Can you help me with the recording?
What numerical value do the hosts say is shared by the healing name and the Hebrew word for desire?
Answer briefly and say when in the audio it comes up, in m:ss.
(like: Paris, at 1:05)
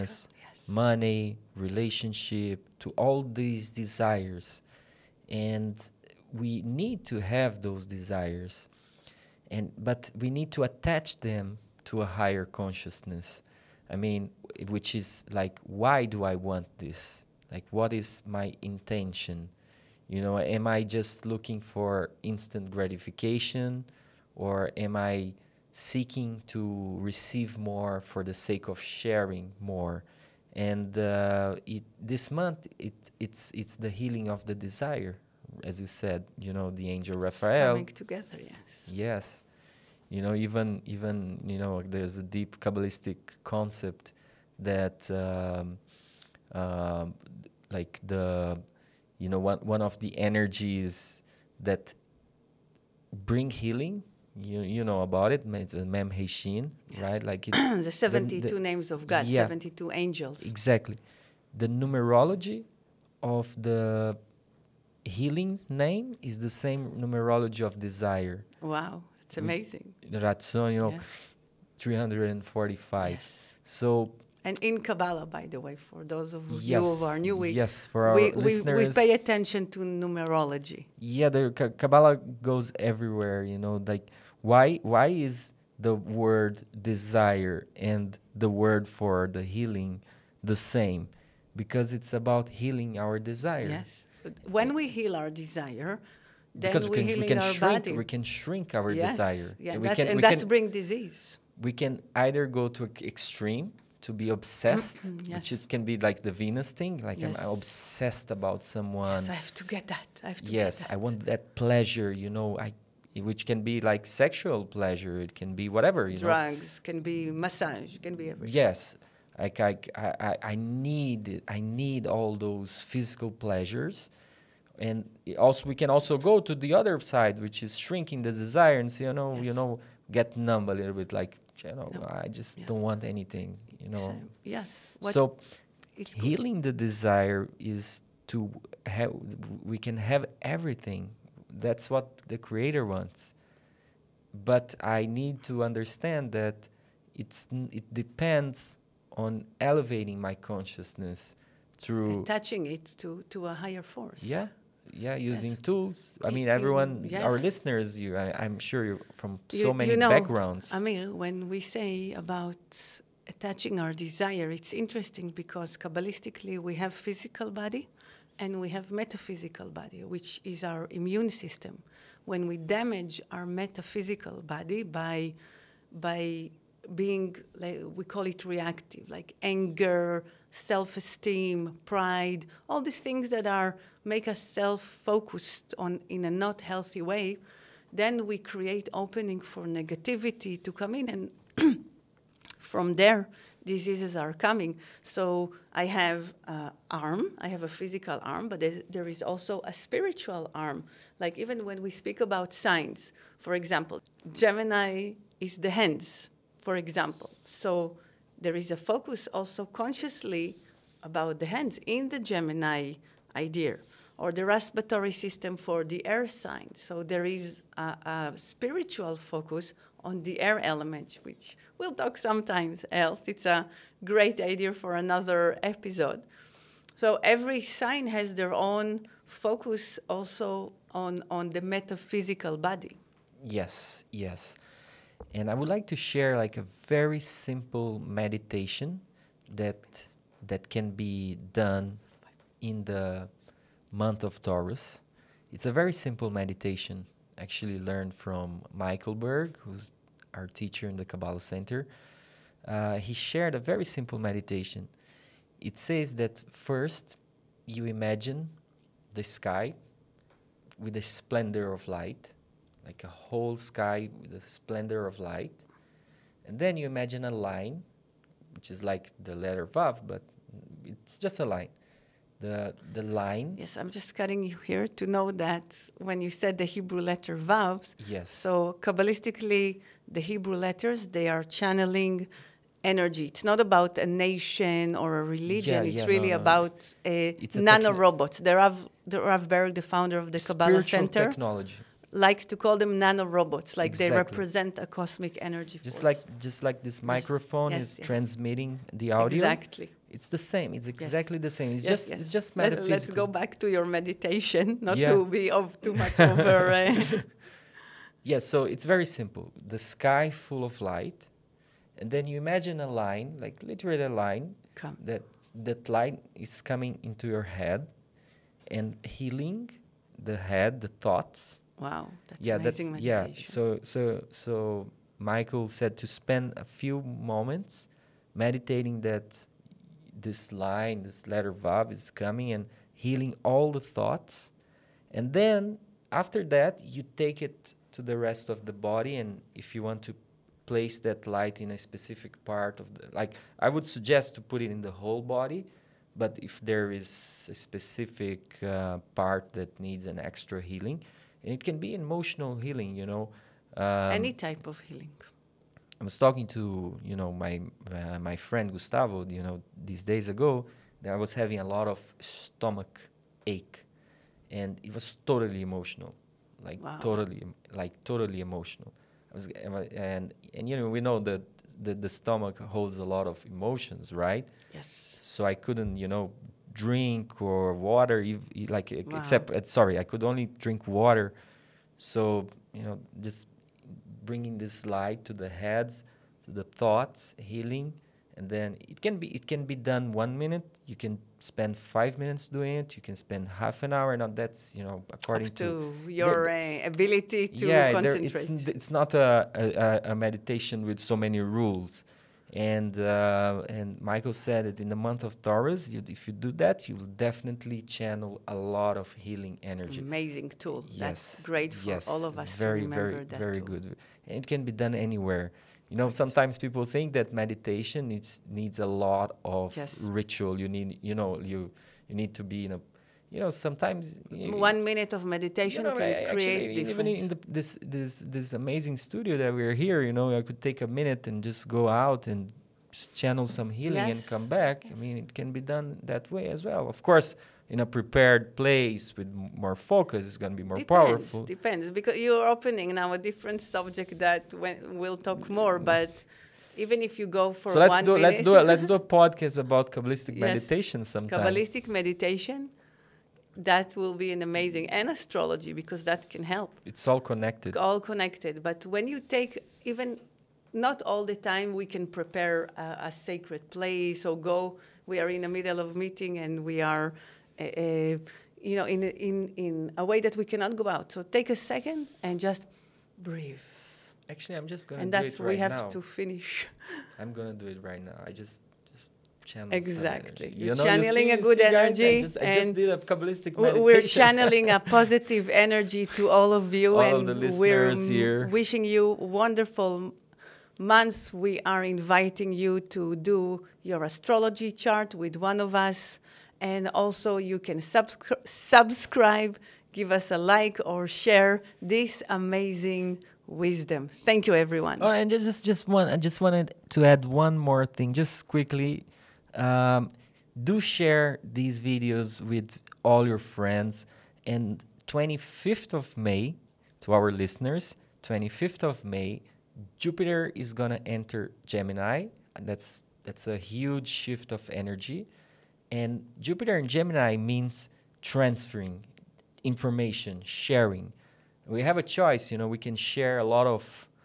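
345, at 1:11.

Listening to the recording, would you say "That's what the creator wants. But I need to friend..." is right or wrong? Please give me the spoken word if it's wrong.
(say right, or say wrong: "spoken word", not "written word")
wrong: "understand", not "friend".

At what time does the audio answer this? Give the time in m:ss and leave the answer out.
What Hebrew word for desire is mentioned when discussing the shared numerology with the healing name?
1:10.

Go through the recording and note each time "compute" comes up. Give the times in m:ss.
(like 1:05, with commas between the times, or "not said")
not said.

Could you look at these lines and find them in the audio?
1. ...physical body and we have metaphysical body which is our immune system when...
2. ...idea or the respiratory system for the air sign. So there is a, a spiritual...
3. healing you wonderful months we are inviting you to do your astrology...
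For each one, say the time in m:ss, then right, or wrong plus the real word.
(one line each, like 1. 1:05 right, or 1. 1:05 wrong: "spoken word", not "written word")
1. 2:46 right
2. 3:33 right
3. 8:08 wrong: "wishing", not "healing".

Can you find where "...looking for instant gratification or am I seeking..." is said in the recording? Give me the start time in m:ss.
0:21.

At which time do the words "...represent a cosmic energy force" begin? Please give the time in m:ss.
4:54.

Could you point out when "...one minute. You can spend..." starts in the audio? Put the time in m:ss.
6:30.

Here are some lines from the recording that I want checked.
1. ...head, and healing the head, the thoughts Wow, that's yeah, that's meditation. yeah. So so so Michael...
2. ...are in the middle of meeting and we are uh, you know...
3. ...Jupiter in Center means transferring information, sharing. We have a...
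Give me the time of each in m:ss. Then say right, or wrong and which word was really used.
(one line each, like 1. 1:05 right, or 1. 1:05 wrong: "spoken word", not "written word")
1. 5:17 right
2. 7:45 right
3. 8:46 wrong: "Gemini", not "Center".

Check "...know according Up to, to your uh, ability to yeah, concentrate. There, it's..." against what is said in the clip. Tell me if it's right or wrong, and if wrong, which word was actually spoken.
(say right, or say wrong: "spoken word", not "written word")
right.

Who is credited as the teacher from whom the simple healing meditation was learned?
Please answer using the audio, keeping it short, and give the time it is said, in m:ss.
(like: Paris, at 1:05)
Michael Berg, at 4:08.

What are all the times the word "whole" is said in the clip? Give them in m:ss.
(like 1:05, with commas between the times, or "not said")
4:23, 5:44.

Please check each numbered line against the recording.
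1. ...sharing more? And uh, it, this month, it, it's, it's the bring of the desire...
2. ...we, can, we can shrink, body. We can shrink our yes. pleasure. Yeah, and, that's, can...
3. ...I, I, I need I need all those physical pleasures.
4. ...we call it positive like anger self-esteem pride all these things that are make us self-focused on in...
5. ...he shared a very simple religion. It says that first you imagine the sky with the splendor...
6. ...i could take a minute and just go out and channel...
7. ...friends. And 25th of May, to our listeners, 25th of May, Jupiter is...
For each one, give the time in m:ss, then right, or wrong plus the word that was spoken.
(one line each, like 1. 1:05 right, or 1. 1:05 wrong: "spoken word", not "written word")
1. 0:28 wrong: "healing", not "bring"
2. 1:36 wrong: "desire", not "pleasure"
3. 1:59 right
4. 2:57 wrong: "reactive", not "positive"
5. 4:12 wrong: "meditation", not "religion"
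6. 7:10 right
7. 8:33 right.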